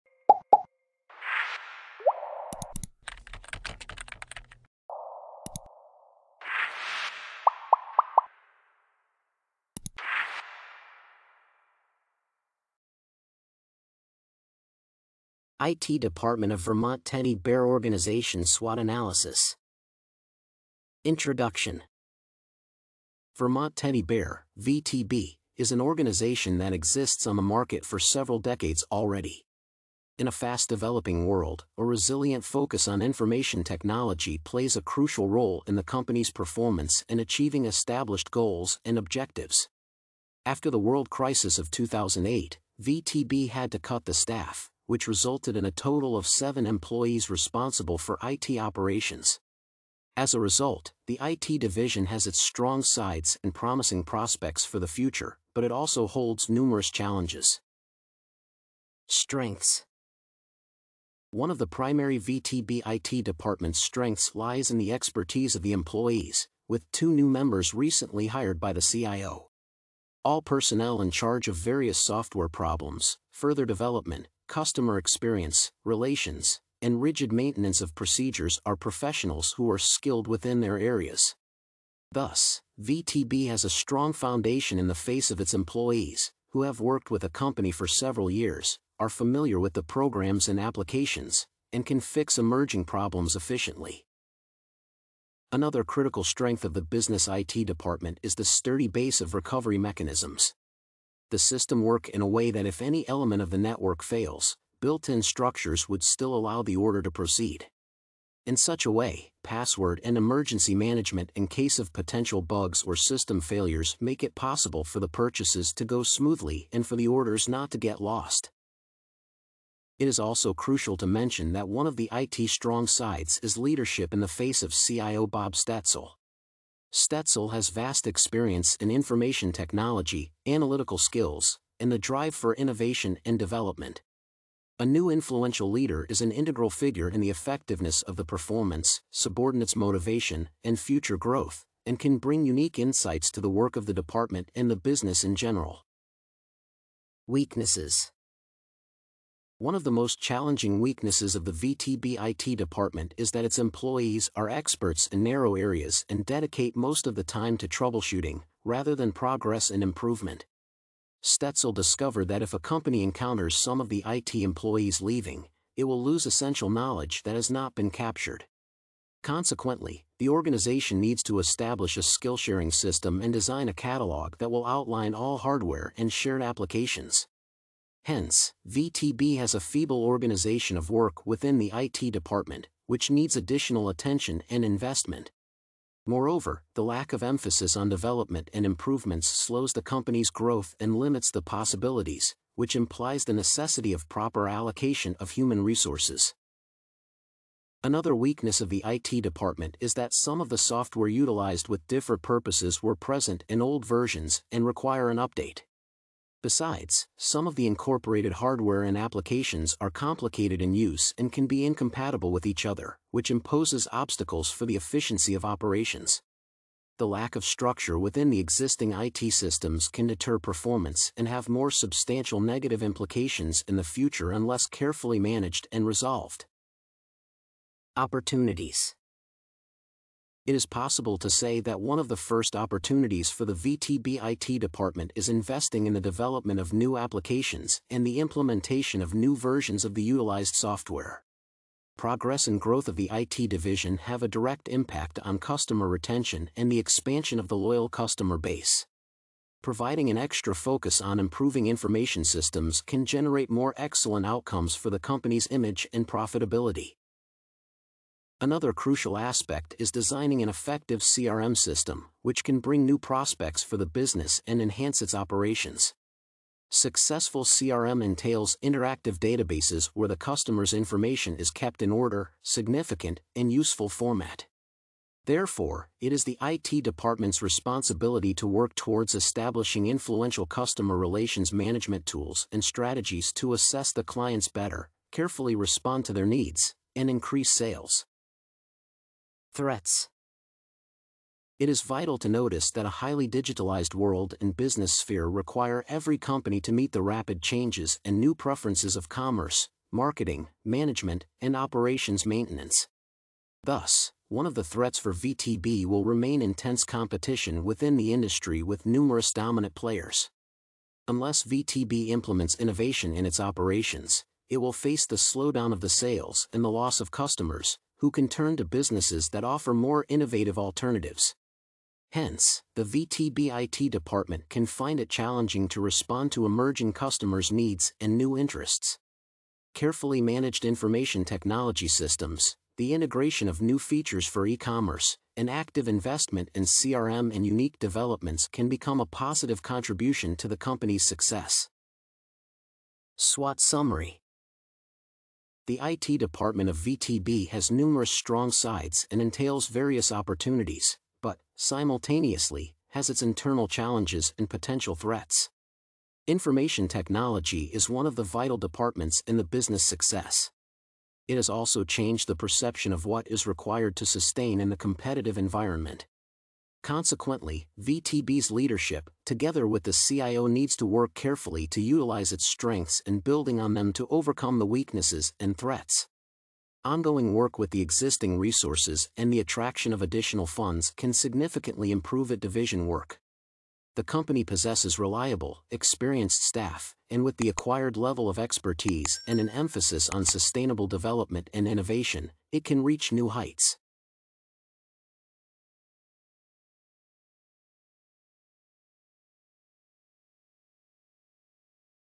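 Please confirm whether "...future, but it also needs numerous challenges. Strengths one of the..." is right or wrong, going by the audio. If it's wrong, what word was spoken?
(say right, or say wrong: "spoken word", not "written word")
wrong: "holds", not "needs".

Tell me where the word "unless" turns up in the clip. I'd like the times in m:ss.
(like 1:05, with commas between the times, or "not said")
3:44, 5:11.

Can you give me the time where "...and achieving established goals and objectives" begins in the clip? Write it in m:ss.
0:37.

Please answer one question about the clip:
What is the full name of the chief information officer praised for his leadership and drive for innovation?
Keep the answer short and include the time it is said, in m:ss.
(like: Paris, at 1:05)
Bob Stetzel, at 2:05.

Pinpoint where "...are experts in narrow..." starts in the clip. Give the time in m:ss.
2:34.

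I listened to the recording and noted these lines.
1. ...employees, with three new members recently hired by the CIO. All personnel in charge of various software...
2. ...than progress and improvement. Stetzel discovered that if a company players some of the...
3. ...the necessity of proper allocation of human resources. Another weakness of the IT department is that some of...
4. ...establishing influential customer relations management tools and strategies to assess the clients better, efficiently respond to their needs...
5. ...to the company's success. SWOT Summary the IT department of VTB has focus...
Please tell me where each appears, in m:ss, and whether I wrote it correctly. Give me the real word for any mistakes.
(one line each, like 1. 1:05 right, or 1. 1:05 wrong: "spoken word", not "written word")
1. 1:05 wrong: "two", not "three"
2. 2:38 wrong: "encounters", not "players"
3. 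3:13 right
4. 4:39 wrong: "carefully", not "efficiently"
5. 5:40 wrong: "numerous", not "focus".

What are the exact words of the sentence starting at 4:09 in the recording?
Providing an extra focus on improving information systems can generate more excellent outcomes for the company's image and profitability.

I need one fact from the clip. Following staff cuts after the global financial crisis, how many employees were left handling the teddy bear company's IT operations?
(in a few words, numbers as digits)
7.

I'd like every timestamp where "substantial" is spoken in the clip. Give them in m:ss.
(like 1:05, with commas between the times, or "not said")
3:41.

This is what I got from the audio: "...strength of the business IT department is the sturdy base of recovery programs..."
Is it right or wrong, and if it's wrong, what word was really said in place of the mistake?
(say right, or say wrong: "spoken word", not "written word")
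wrong: "mechanisms", not "programs".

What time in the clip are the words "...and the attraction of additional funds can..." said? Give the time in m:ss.
6:19.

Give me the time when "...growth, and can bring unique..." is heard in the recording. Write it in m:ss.
2:21.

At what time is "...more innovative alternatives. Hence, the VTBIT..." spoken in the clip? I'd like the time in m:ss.
5:19.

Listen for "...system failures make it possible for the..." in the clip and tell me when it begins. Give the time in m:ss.
1:52.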